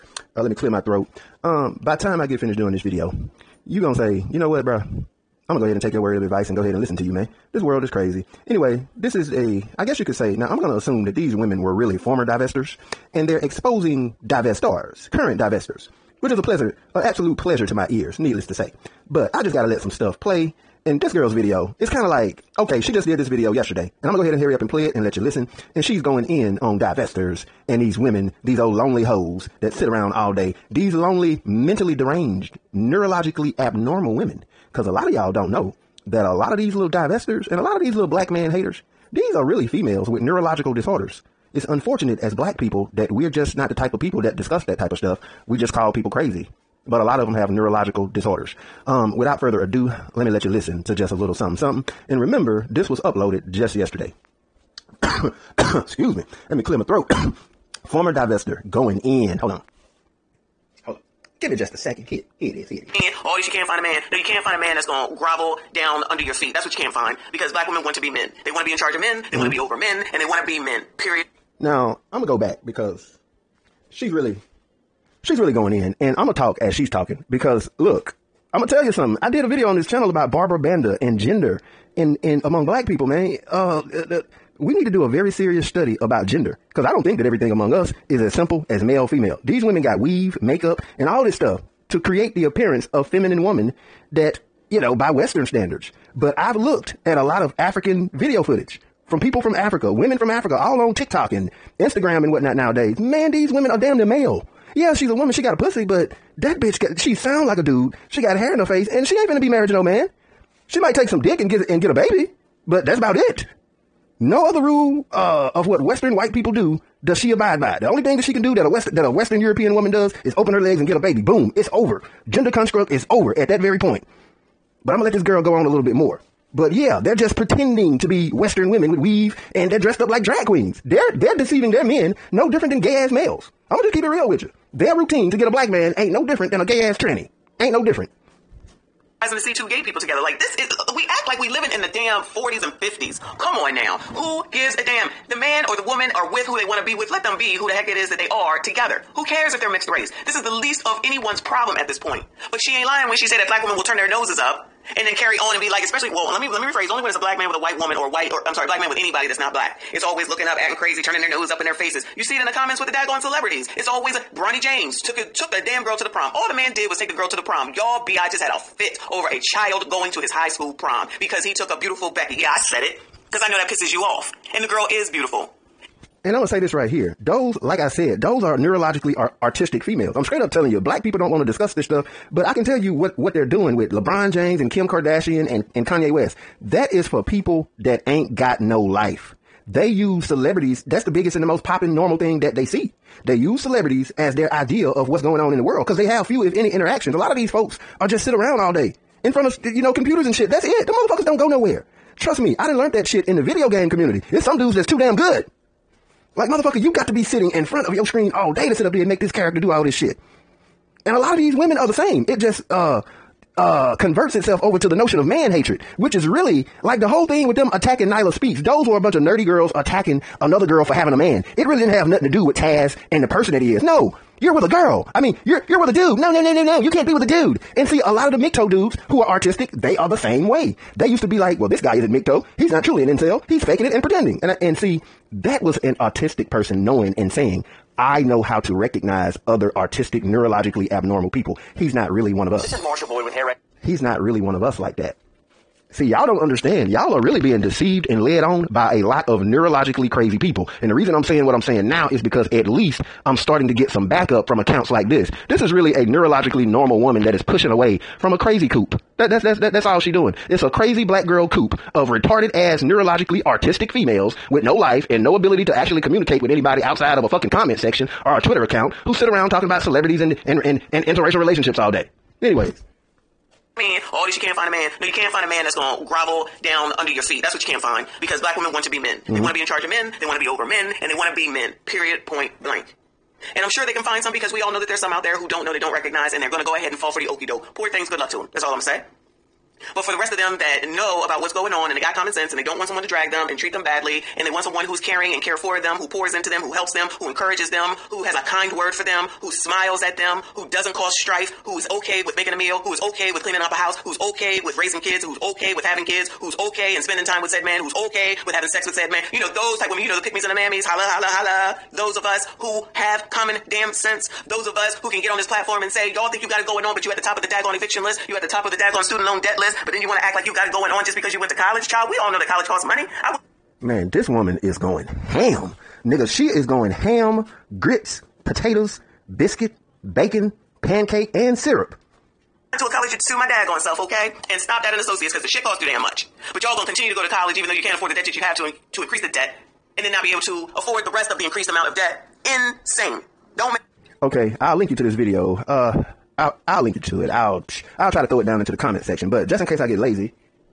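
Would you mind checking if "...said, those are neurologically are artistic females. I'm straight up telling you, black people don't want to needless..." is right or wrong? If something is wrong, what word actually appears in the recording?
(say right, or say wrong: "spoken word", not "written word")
wrong: "discuss", not "needless".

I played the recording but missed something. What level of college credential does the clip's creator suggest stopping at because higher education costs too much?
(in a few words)
associates.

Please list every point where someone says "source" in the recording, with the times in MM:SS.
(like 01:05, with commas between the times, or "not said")
not said.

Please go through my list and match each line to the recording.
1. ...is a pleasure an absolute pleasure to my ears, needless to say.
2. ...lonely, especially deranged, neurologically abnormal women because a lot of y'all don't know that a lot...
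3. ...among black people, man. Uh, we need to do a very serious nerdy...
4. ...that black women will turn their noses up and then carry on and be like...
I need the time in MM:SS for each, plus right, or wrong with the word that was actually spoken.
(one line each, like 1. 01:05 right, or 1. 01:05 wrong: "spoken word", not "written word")
1. 00:16 right
2. 00:30 wrong: "mentally", not "especially"
3. 01:22 wrong: "study", not "nerdy"
4. 02:33 right.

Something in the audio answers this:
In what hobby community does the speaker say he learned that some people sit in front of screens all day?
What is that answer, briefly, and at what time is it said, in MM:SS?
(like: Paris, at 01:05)
video game community, at 03:23.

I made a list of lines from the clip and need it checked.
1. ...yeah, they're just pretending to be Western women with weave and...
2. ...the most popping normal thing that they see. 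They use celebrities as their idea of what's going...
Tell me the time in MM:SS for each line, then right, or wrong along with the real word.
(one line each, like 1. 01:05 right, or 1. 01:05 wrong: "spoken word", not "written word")
1. 02:06 right
2. 03:11 right.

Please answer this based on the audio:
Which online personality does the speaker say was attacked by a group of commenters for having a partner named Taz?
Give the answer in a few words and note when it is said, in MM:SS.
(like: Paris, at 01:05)
Nyla Speaks, at 03:38.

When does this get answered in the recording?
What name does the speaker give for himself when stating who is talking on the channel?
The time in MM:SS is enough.
04:02.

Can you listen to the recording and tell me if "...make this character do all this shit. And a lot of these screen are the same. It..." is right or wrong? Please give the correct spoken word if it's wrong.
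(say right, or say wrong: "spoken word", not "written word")
wrong: "women", not "screen".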